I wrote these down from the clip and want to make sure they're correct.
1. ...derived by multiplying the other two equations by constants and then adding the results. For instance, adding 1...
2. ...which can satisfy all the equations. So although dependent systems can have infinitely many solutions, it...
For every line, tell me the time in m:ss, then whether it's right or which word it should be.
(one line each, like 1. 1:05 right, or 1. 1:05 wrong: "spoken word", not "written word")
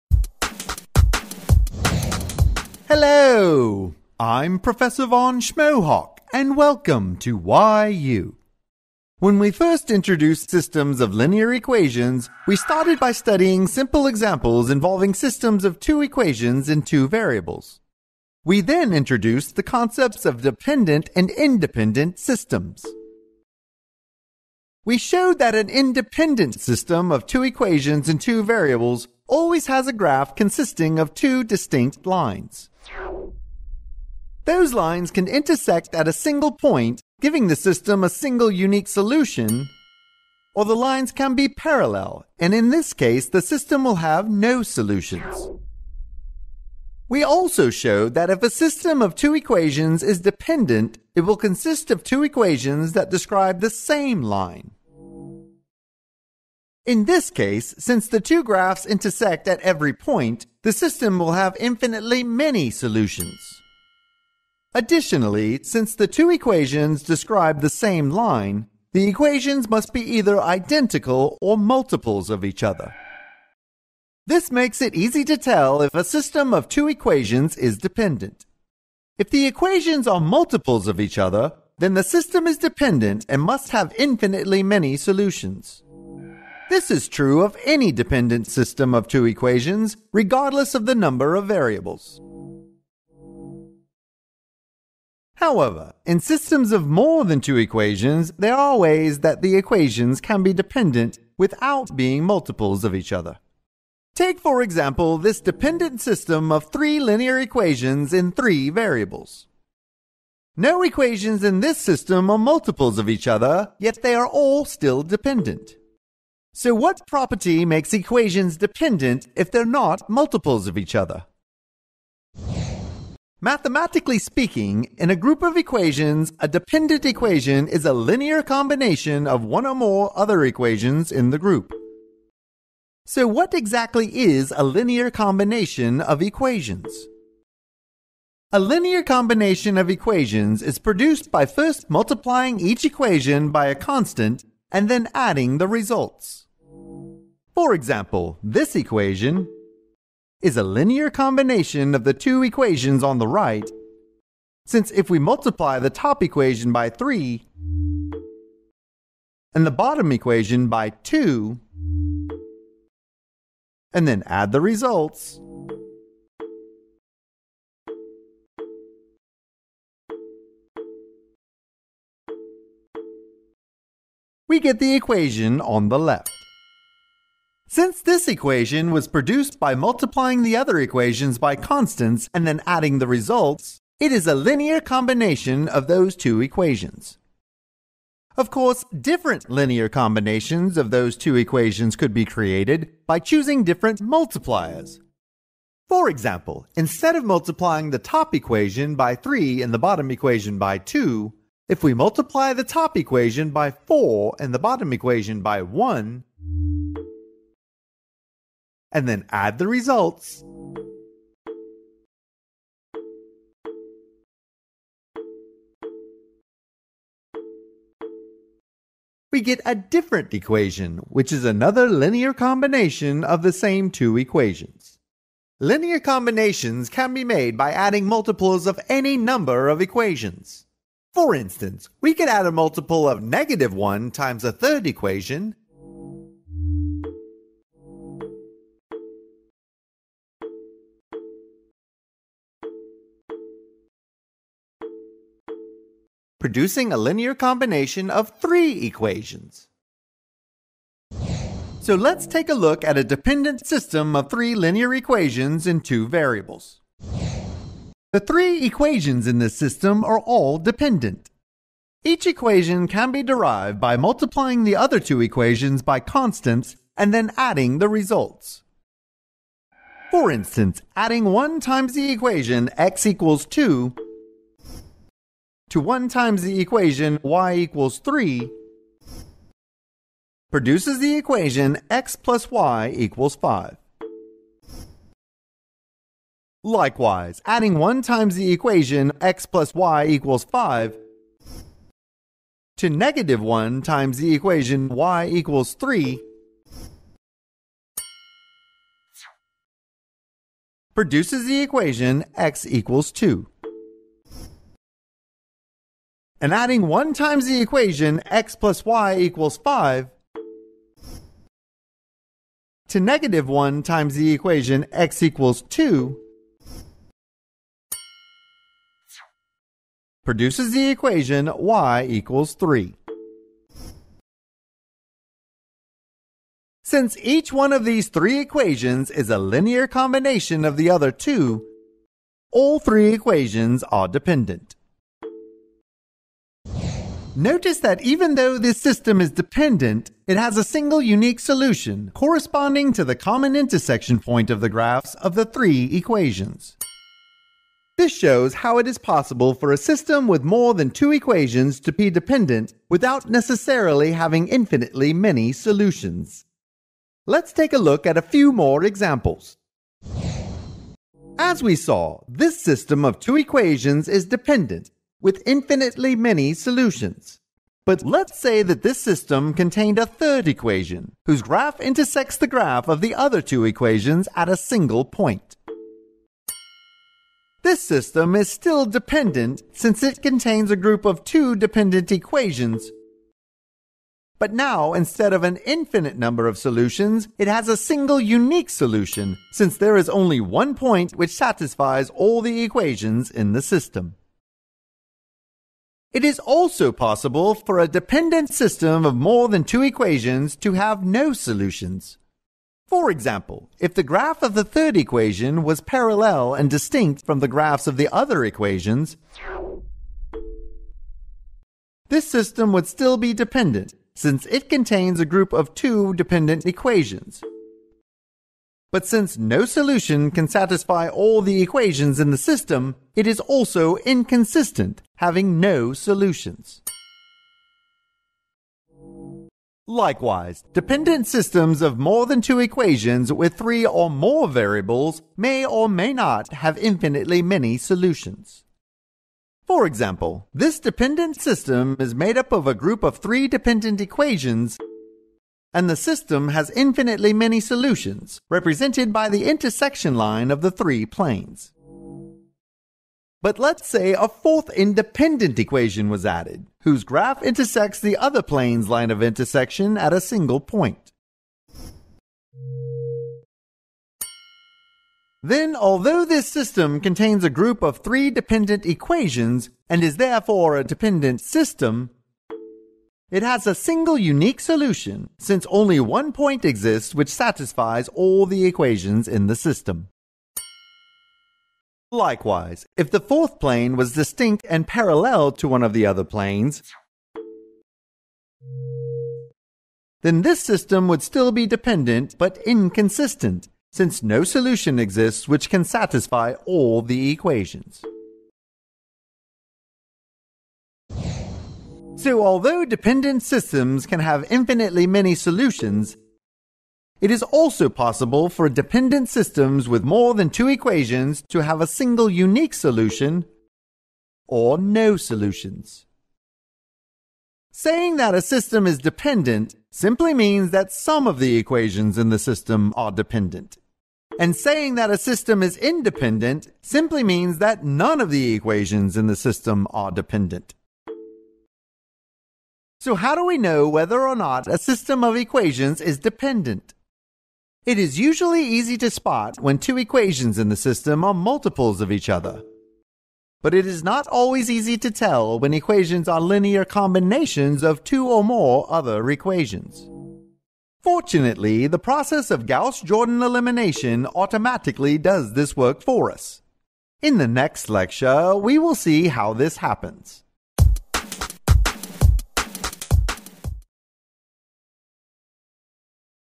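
1. 4:23 right
2. 8:15 right.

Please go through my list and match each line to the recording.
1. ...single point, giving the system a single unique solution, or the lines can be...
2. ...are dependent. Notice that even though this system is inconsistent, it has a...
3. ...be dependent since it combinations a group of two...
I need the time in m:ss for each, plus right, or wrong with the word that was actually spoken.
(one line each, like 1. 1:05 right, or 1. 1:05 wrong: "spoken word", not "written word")
1. 0:36 right
2. 5:33 wrong: "dependent", not "inconsistent"
3. 6:53 wrong: "contains", not "combinations".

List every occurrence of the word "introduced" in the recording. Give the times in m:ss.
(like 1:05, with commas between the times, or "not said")
0:09, 0:18.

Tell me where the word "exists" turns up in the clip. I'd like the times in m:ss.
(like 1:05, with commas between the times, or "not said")
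7:56, 8:14.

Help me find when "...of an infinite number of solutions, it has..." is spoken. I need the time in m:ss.
6:25.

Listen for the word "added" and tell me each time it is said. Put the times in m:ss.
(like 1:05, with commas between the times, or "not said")
7:36.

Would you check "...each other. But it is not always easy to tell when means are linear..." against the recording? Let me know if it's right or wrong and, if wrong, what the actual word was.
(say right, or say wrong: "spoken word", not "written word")
wrong: "equations", not "means".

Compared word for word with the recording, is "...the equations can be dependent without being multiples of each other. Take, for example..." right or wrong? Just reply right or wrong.
right.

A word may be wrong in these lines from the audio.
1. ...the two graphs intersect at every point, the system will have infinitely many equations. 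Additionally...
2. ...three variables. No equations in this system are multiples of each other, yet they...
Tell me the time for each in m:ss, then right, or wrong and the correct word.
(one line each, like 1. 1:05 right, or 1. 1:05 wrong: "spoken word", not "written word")
1. 0:58 wrong: "solutions", not "equations"
2. 1:48 right.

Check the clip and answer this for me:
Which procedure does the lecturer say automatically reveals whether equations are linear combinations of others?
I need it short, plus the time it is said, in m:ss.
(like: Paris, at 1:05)
Gauss-Jordan elimination, at 9:12.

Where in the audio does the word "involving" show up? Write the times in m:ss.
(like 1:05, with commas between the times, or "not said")
0:14.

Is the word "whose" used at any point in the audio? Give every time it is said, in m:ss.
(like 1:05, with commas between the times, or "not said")
6:11, 7:36.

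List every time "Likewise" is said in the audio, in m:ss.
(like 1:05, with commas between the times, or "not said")
4:46, 7:09, 8:02.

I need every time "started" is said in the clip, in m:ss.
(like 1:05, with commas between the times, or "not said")
0:12.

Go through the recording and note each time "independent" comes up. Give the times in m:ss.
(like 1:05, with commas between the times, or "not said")
0:21, 0:25, 7:34, 8:45.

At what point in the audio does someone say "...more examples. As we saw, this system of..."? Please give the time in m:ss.
5:58.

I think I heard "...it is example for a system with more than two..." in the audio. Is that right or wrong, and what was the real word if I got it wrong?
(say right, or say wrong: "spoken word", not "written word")
wrong: "possible", not "example".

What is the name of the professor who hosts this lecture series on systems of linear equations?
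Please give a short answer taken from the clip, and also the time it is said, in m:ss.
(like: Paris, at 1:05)
Von Schmohawk, at 0:04.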